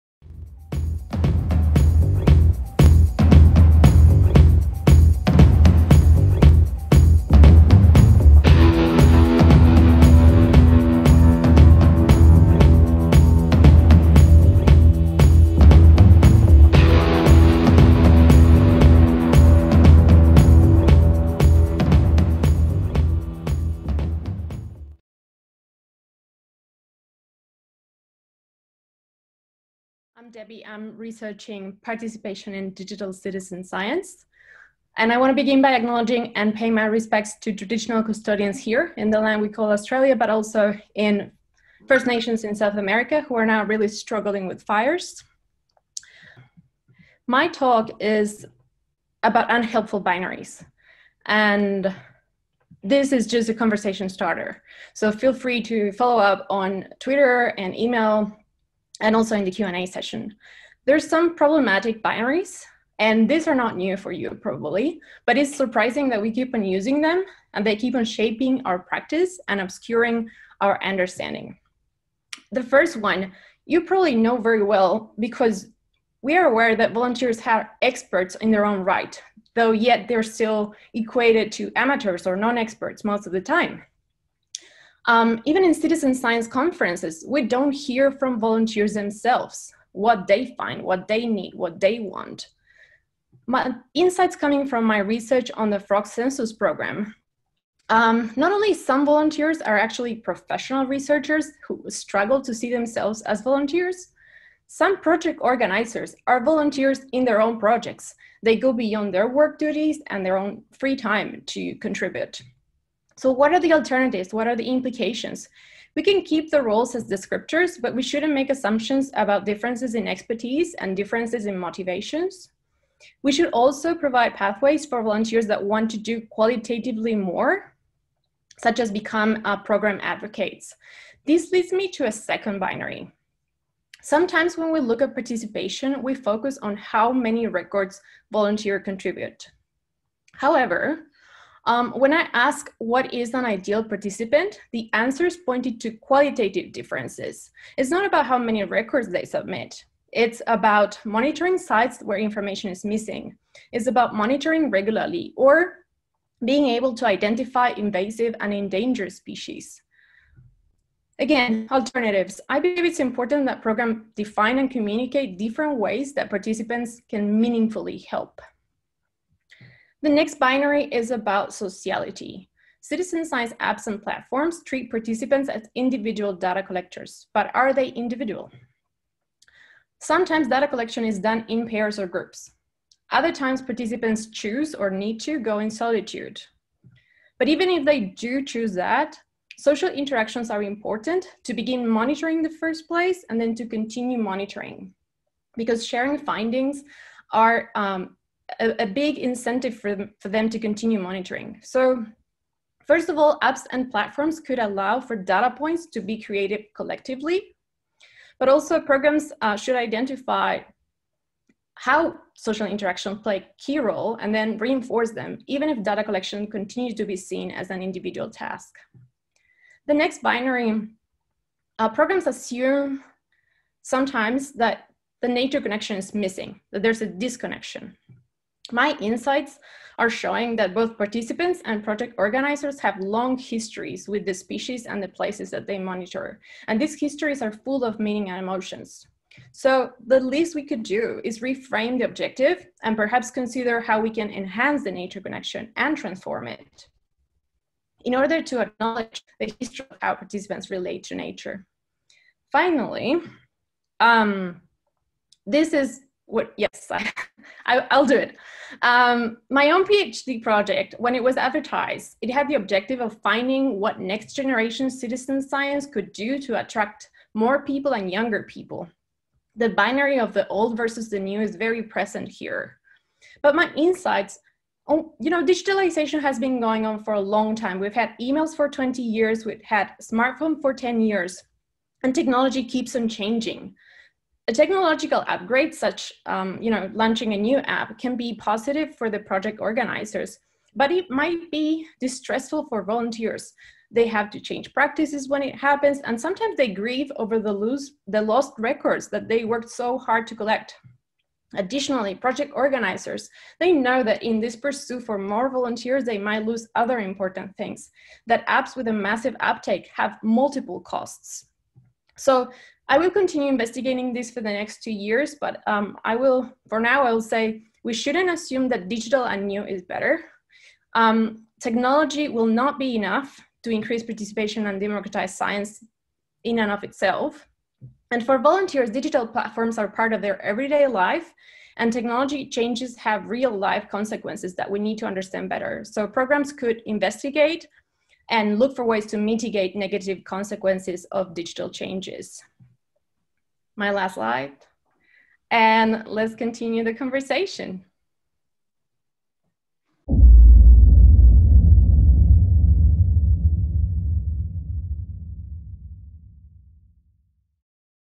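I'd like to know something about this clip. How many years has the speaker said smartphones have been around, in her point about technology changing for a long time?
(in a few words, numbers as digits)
10 years.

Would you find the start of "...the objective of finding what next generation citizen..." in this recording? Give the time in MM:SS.
04:22.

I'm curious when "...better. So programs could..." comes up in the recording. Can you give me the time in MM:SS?
05:35.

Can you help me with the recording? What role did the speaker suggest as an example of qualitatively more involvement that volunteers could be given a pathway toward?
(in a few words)
program advocates.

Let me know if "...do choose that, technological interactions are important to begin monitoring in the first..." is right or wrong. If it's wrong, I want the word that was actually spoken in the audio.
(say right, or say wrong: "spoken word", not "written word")
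wrong: "social", not "technological".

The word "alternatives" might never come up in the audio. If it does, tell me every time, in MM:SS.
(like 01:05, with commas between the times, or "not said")
01:53, 02:41.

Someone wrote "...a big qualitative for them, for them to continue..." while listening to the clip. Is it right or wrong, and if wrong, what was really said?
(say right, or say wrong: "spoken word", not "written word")
wrong: "incentive", not "qualitative".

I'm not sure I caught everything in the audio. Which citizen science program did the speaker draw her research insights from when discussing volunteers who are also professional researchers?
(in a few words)
frog census program.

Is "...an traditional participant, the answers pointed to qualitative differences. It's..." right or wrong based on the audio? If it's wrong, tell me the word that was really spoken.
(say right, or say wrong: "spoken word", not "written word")
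wrong: "ideal", not "traditional".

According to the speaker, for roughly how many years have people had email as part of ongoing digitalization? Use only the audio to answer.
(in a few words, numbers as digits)
20 years.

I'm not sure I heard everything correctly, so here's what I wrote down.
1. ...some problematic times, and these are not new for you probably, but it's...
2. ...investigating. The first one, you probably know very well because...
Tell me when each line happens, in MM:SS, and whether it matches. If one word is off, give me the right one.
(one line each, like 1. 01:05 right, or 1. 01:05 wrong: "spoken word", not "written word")
1. 01:01 wrong: "binaries", not "times"
2. 01:10 wrong: "understanding", not "investigating".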